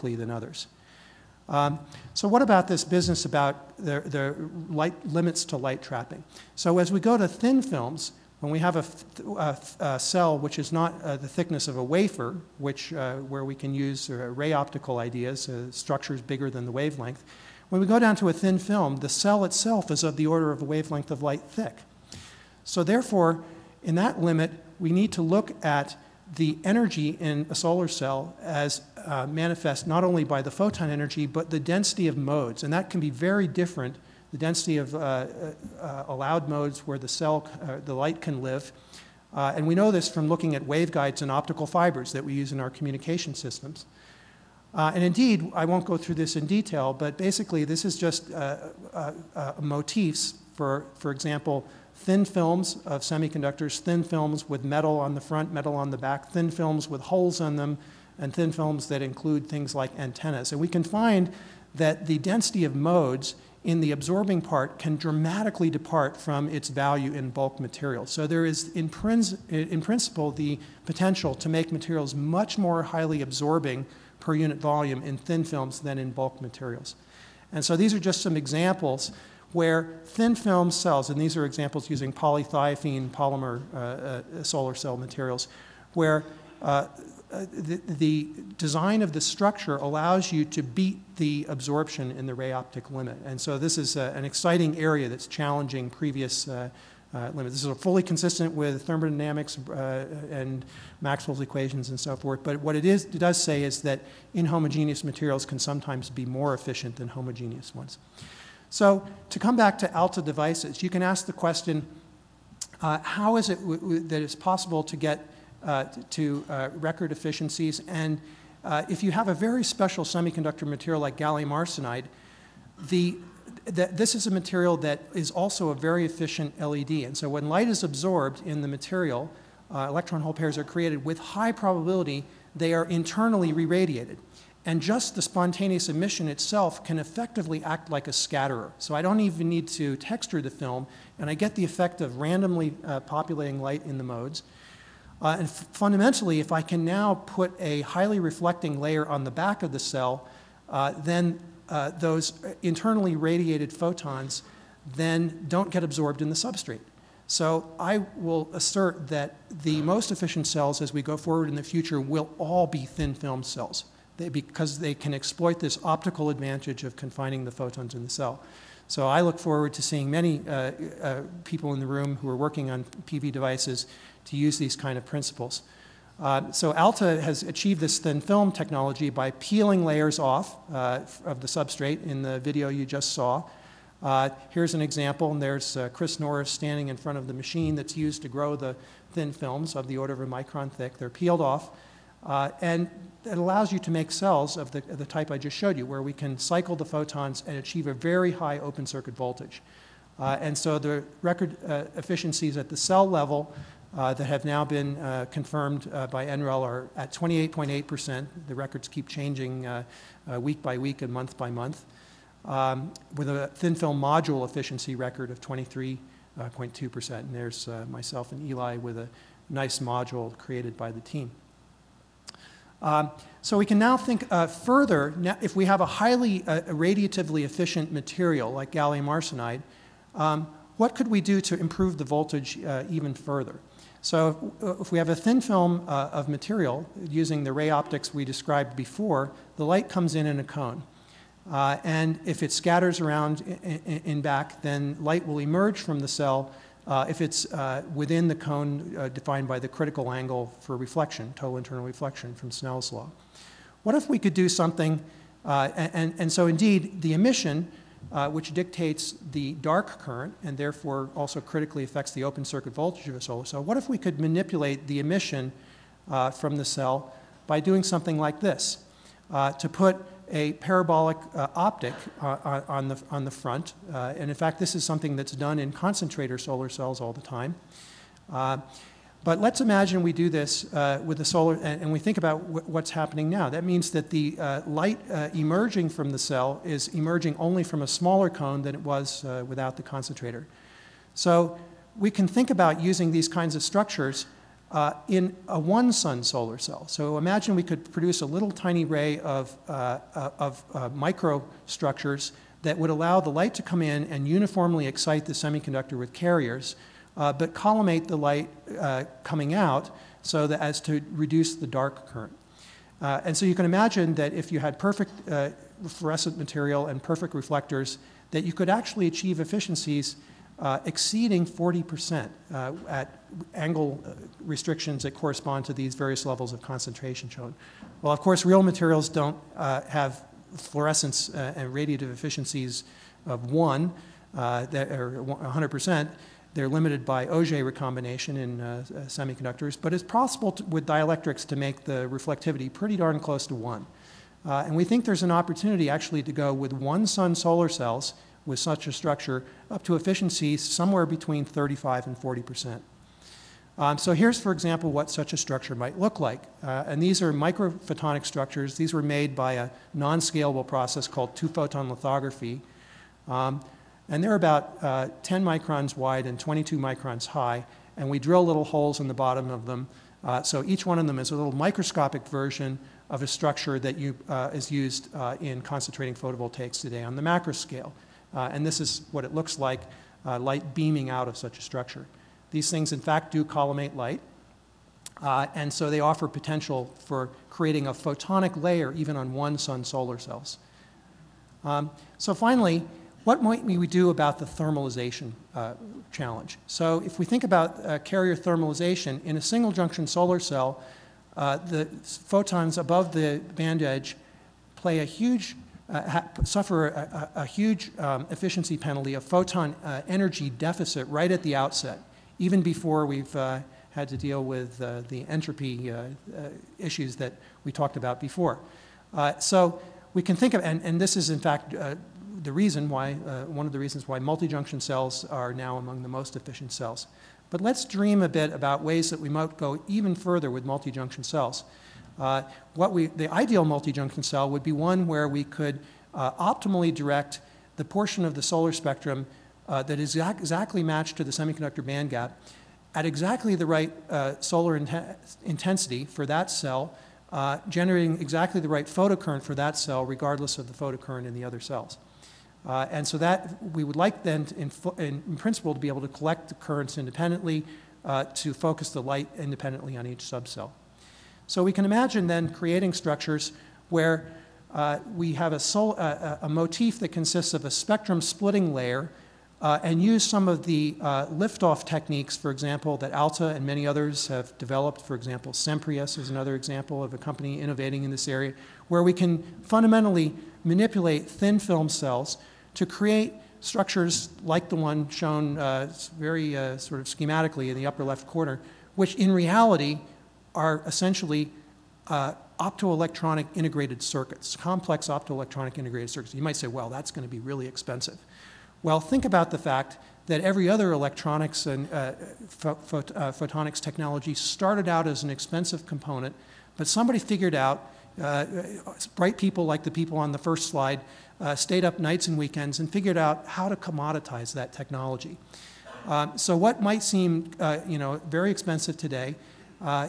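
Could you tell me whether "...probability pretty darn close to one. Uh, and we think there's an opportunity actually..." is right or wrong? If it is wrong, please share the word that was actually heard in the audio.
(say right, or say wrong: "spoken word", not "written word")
wrong: "reflectivity", not "probability".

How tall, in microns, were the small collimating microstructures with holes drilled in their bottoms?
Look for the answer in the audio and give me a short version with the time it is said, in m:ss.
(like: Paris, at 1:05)
22 microns, at 6:06.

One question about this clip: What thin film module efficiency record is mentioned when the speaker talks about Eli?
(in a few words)
23.2%.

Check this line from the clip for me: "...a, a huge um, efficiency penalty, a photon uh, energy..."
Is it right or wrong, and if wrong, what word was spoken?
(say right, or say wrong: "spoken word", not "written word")
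right.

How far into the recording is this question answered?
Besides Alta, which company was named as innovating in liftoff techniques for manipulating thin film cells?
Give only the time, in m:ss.
7:55.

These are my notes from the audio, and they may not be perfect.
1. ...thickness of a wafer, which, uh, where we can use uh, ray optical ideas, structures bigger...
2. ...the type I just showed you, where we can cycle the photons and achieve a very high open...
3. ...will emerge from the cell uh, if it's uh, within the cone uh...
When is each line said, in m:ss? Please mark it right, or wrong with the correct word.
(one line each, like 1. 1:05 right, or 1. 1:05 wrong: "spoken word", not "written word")
1. 0:11 right
2. 3:14 right
3. 4:05 right.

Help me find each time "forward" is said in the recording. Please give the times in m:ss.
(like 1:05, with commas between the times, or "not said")
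2:41, 2:49.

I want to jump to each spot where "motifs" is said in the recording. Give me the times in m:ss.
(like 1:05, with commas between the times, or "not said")
0:49, 7:46.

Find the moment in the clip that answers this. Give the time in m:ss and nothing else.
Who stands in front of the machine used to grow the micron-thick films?
3:05.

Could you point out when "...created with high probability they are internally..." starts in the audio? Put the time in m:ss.
2:10.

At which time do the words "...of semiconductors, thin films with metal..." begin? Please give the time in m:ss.
0:52.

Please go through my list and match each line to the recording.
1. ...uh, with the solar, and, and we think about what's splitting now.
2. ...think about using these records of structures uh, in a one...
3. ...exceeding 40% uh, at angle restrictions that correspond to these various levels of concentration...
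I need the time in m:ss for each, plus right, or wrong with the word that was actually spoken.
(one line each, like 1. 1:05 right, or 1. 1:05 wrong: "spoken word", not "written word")
1. 4:40 wrong: "happening", not "splitting"
2. 4:52 wrong: "kinds", not "records"
3. 5:20 right.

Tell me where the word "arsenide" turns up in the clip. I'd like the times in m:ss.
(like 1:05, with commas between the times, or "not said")
2:01, 3:49.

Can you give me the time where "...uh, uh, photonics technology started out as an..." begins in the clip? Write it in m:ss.
8:21.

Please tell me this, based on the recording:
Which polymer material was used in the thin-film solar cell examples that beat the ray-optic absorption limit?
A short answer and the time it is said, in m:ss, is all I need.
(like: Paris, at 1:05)
polythiophene, at 1:22.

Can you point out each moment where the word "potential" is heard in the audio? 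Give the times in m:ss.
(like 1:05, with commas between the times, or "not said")
1:10, 6:26.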